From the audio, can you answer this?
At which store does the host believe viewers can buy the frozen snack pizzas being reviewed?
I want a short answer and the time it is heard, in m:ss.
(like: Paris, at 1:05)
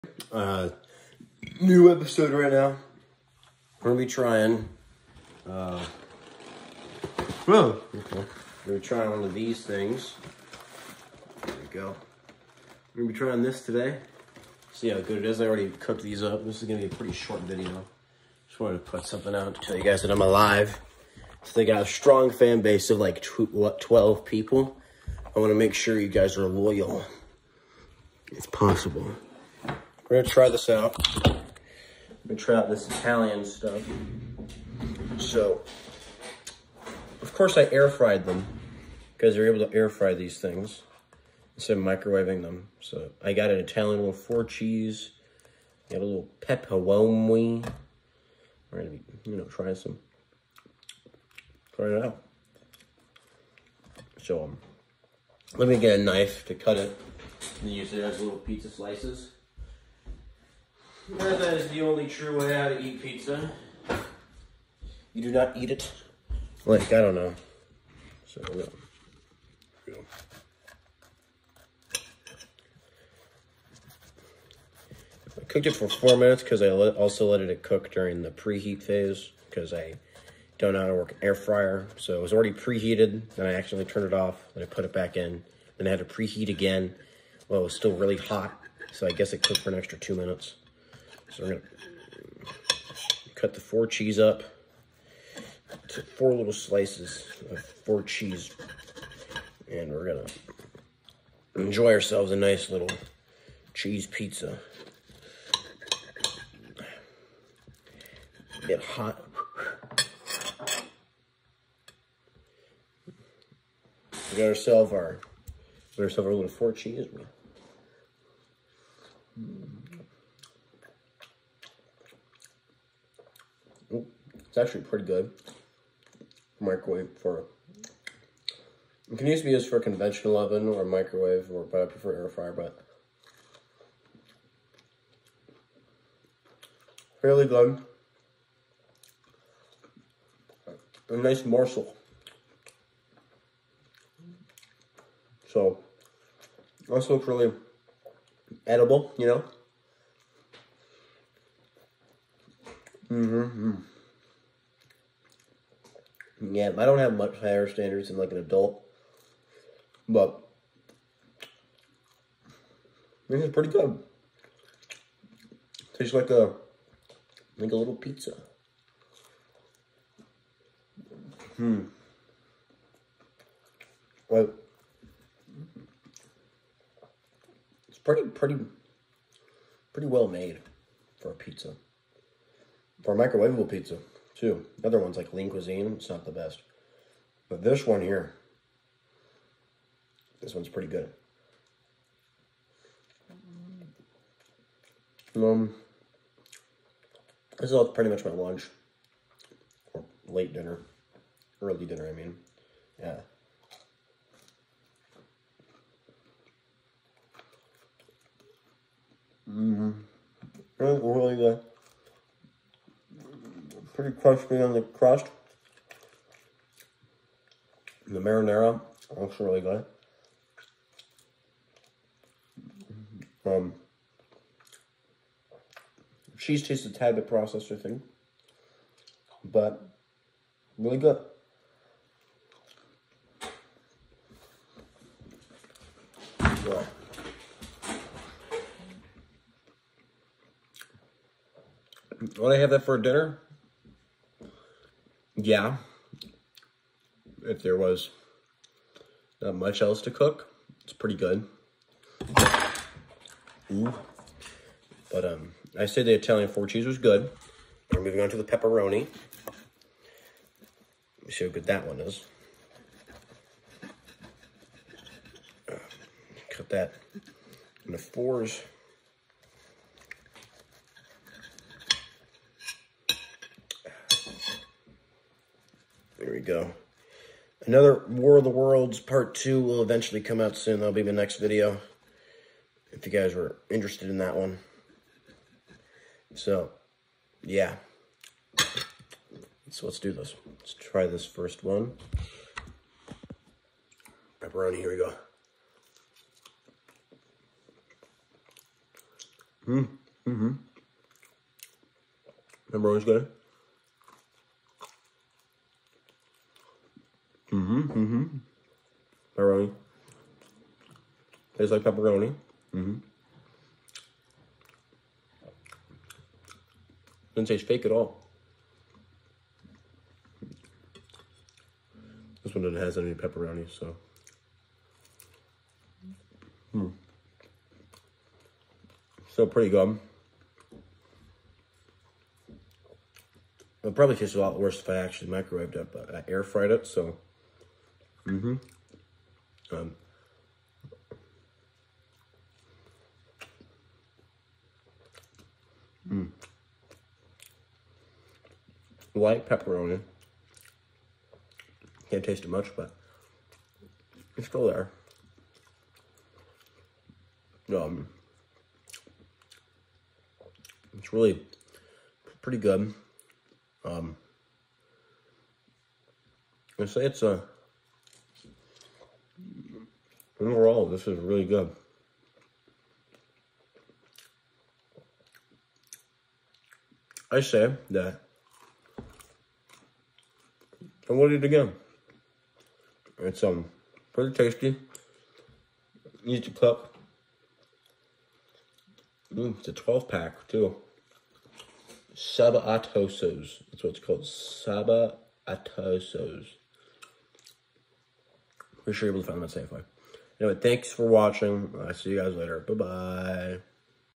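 Safeway, at 6:39.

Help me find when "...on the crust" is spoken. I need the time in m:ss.
3:34.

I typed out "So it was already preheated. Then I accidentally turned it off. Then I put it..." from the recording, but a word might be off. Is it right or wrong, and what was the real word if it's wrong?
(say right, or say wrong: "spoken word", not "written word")
right.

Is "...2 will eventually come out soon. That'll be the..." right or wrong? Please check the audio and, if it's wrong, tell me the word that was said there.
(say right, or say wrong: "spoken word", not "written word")
right.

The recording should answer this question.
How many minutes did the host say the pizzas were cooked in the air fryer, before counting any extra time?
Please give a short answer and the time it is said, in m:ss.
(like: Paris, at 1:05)
4, at 1:15.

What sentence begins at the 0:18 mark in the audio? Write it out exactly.
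Just wanted to put something out to tell you guys that I'm alive.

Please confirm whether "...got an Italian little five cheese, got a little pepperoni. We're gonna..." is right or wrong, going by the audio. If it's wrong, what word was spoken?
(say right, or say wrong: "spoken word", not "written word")
wrong: "four", not "five".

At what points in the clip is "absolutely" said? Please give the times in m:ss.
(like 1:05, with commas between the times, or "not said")
not said.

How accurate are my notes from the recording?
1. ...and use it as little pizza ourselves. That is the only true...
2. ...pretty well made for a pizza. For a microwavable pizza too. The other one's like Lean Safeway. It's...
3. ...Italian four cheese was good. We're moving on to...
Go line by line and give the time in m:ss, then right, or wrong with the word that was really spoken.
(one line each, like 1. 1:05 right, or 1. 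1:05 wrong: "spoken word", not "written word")
1. 0:57 wrong: "slices", not "ourselves"
2. 2:59 wrong: "Cuisine", not "Safeway"
3. 4:16 right.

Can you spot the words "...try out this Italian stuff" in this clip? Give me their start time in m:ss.
0:32.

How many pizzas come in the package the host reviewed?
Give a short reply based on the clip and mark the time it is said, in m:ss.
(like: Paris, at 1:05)
12, at 6:29.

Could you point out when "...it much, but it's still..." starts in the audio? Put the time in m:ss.
5:52.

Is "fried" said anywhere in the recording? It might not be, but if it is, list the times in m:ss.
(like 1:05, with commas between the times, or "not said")
0:37, 5:36.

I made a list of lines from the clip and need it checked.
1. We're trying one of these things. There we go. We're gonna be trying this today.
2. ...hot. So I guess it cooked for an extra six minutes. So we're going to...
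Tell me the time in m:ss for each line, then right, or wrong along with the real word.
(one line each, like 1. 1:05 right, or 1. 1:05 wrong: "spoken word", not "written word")
1. 0:08 right
2. 1:28 wrong: "two", not "six".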